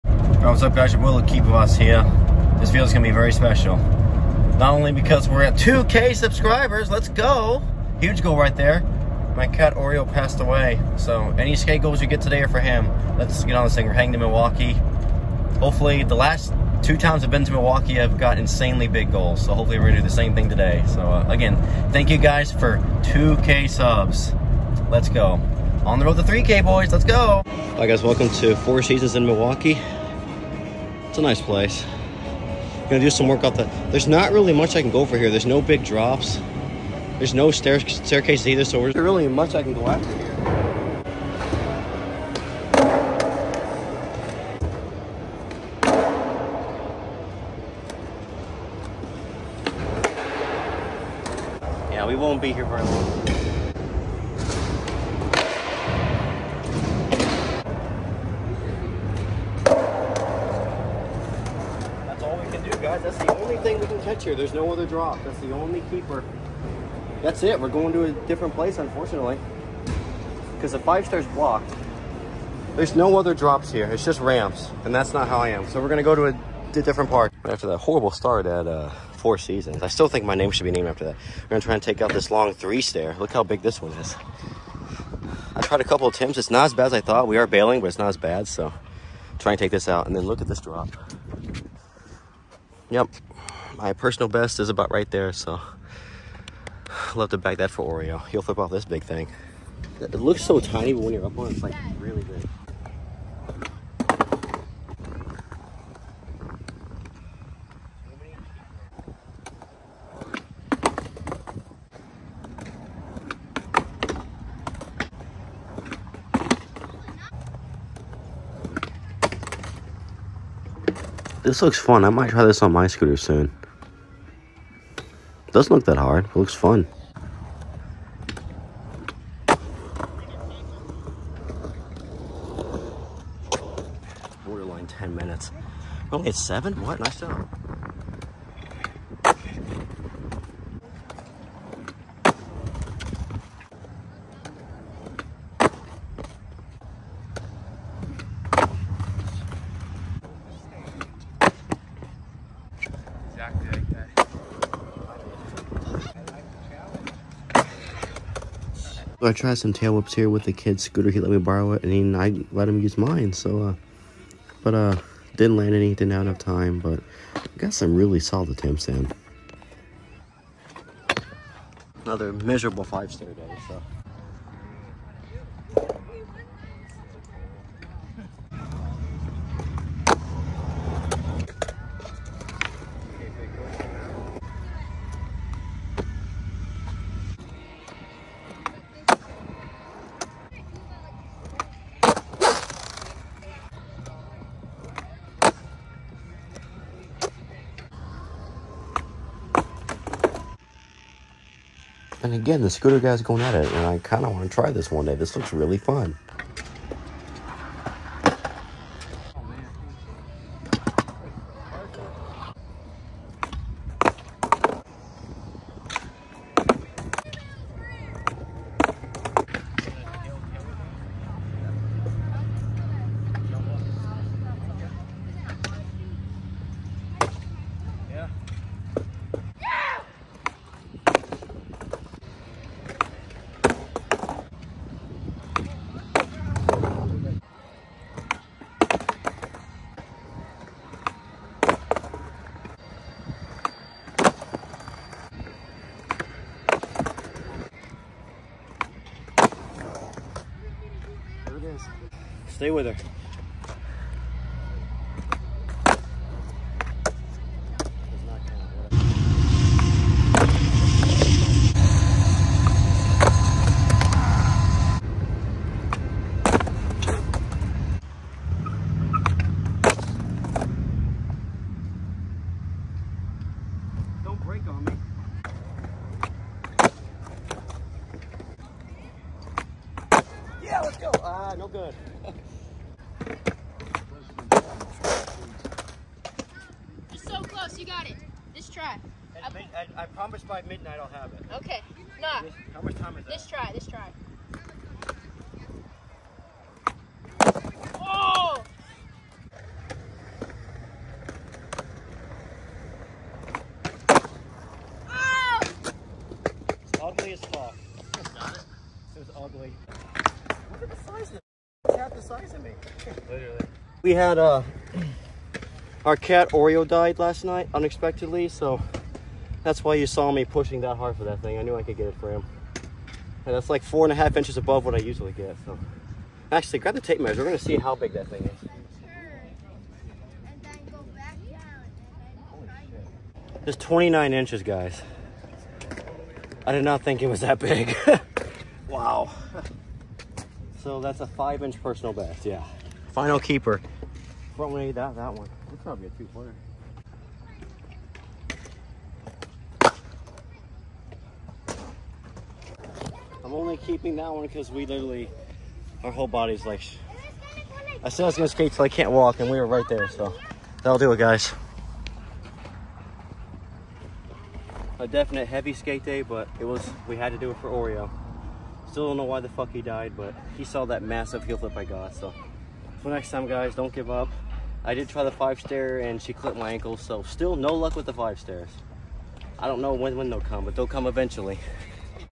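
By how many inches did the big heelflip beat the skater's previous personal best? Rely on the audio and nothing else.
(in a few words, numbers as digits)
5.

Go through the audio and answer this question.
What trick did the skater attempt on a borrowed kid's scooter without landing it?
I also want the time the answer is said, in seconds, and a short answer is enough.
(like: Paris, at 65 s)
tail whips, at 159 s.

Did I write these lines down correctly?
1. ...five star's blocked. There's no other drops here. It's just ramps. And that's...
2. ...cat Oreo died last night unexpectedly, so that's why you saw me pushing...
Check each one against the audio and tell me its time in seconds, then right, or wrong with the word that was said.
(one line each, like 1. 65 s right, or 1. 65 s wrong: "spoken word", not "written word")
1. 70 s right
2. 316 s right.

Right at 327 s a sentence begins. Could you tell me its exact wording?
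We're gonna see how big that thing is.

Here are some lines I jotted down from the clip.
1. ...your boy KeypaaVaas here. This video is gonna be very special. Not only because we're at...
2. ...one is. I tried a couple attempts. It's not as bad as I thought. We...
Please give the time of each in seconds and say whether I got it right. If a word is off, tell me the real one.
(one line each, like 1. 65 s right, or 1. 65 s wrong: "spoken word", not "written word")
1. 0 s right
2. 83 s right.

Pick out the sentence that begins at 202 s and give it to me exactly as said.
And again, the scooter guy's going at it, and I kind of want to try this one day.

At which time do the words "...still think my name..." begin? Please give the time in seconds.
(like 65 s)
79 s.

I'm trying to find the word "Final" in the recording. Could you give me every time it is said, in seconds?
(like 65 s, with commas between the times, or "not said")
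343 s.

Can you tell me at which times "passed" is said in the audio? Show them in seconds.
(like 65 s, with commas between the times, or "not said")
10 s.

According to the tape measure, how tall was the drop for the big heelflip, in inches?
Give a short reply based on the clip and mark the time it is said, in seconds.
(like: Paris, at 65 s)
29, at 333 s.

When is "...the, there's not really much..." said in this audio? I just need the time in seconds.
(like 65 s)
33 s.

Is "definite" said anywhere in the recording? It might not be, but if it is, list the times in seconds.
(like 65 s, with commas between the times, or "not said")
365 s.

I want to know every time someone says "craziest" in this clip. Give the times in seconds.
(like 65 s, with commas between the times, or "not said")
not said.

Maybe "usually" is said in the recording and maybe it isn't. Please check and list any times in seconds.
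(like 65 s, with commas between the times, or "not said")
324 s.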